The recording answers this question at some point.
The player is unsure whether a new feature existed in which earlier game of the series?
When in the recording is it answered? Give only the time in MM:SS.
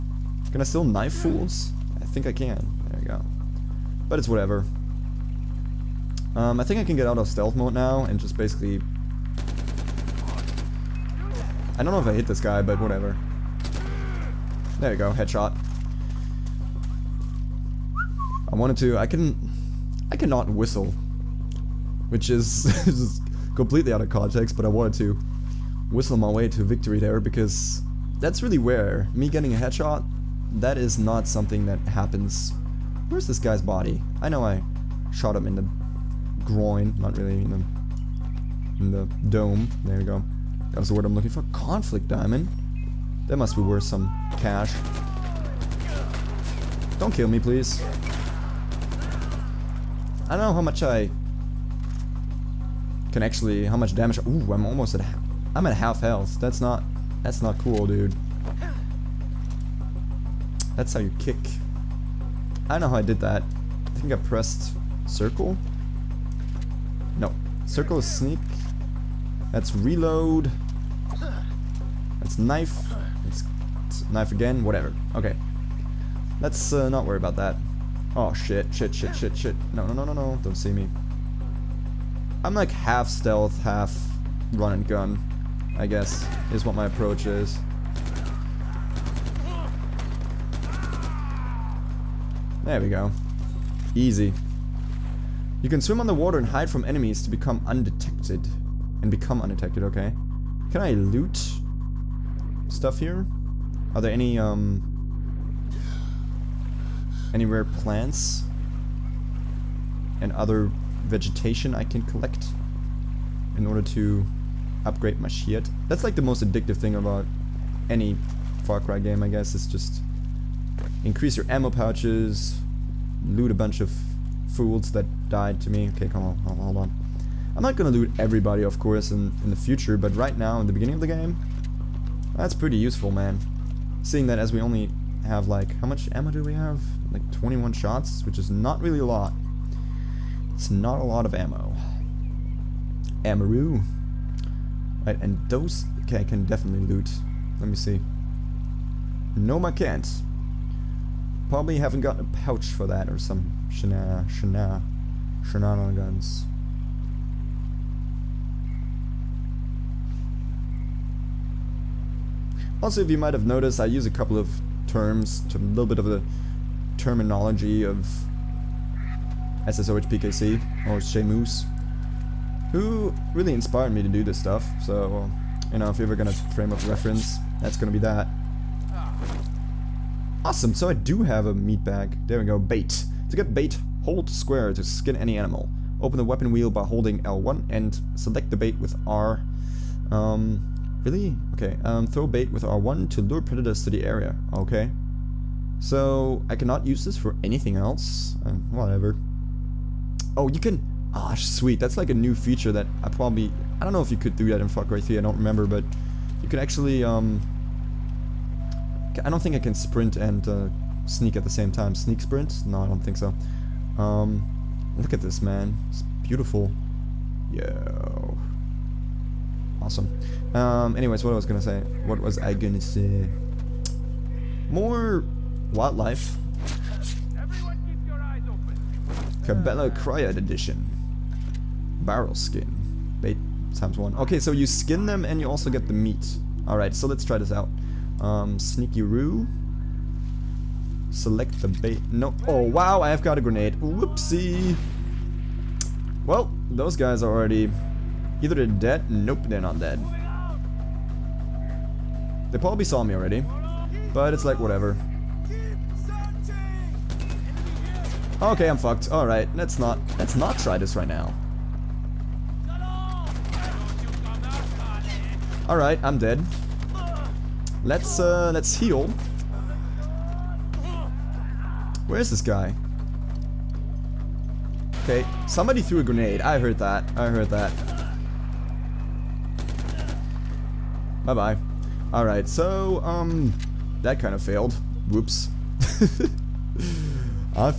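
03:24.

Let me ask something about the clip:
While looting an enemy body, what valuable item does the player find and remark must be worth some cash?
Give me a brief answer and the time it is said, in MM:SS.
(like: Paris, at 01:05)
Conflict diamond, at 00:41.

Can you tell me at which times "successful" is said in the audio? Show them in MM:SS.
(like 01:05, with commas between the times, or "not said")
not said.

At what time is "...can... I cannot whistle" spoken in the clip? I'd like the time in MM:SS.
00:19.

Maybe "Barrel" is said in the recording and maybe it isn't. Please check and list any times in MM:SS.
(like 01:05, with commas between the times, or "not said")
03:52.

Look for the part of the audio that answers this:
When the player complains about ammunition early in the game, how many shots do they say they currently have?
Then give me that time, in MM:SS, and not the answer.
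02:17.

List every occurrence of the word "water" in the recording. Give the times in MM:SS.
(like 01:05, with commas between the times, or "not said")
01:36.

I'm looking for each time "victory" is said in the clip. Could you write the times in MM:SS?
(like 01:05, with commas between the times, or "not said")
00:26.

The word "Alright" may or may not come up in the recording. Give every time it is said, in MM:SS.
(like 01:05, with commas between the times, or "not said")
03:56, 04:19, 04:25, 04:42.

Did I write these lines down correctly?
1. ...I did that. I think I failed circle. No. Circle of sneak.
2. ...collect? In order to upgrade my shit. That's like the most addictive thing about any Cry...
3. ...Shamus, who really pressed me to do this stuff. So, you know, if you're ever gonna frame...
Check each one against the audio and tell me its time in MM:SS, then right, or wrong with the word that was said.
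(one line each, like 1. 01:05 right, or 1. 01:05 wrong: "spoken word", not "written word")
1. 01:02 wrong: "pressed", not "failed"
2. 01:52 wrong: "Far", not "Cry"
3. 02:51 wrong: "inspired", not "pressed".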